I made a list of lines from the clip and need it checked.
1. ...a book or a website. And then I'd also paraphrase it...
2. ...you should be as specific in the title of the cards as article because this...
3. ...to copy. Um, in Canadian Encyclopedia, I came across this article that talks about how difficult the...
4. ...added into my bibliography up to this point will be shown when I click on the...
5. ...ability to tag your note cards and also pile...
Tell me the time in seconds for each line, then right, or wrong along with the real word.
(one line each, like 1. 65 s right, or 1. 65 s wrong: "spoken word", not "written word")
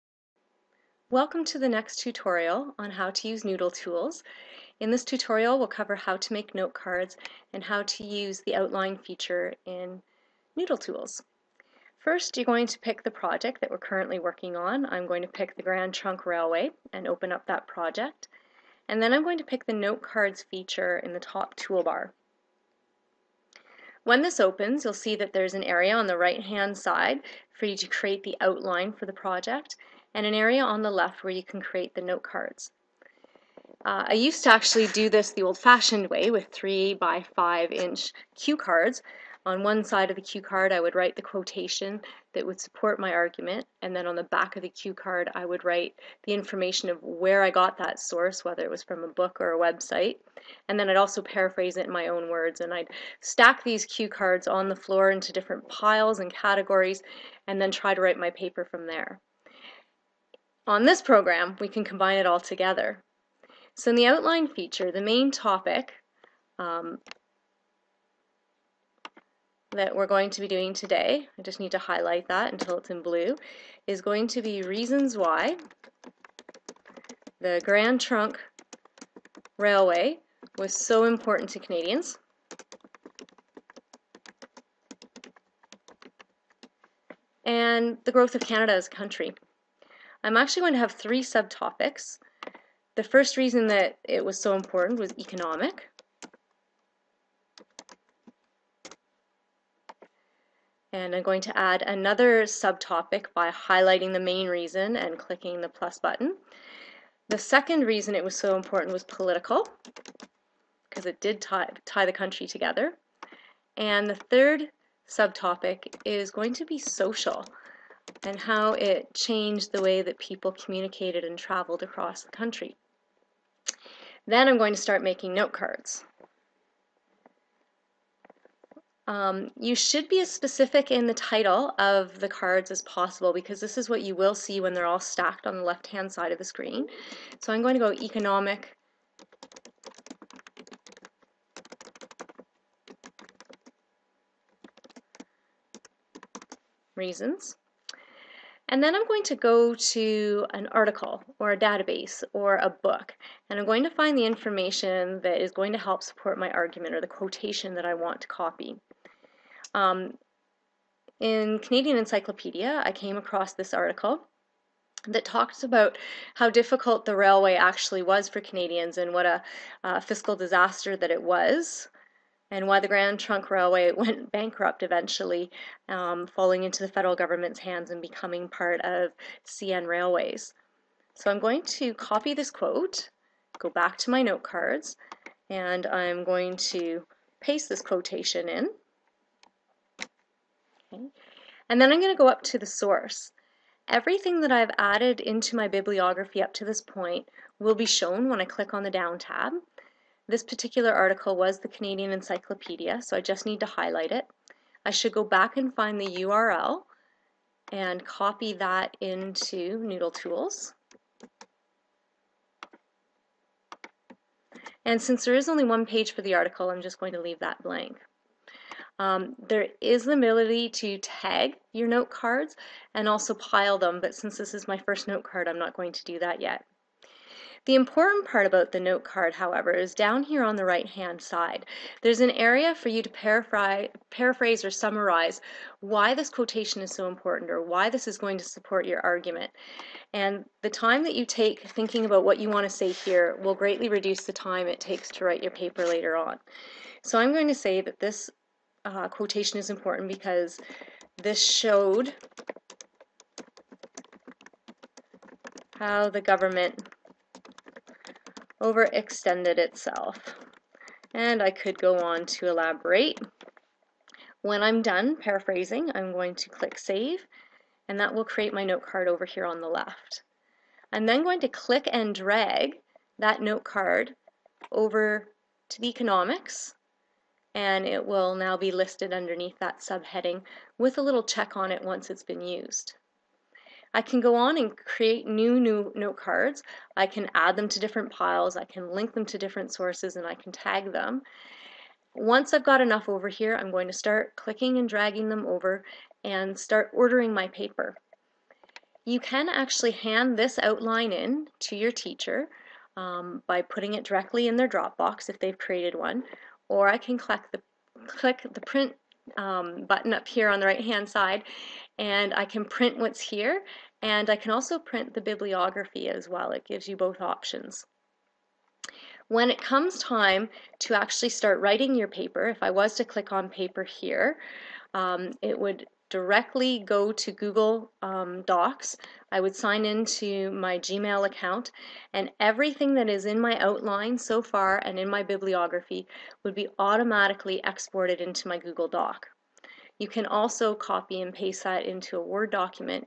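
1. 49 s right
2. 129 s wrong: "possible", not "article"
3. 158 s right
4. 194 s right
5. 220 s right.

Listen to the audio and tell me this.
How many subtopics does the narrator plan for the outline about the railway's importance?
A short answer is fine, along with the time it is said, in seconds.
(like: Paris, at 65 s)
3, at 90 s.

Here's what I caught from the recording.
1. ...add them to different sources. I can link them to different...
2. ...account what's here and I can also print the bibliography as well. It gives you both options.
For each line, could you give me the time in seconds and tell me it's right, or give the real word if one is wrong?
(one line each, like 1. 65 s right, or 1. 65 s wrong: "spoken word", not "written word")
1. 287 s wrong: "piles", not "sources"
2. 312 s wrong: "print", not "account".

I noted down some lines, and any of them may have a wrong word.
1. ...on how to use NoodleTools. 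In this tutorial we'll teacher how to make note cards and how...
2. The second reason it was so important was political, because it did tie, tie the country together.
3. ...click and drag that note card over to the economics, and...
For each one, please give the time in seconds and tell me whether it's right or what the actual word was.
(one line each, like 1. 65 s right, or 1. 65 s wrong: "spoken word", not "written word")
1. 2 s wrong: "cover", not "teacher"
2. 107 s right
3. 271 s right.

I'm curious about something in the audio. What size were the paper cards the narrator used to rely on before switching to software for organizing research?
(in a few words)
3 by 5 inch.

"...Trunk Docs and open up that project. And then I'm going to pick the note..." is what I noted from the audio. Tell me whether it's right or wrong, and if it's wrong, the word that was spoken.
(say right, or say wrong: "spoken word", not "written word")
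wrong: "Railway", not "Docs".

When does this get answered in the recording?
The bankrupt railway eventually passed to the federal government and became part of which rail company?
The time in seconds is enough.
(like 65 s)
179 s.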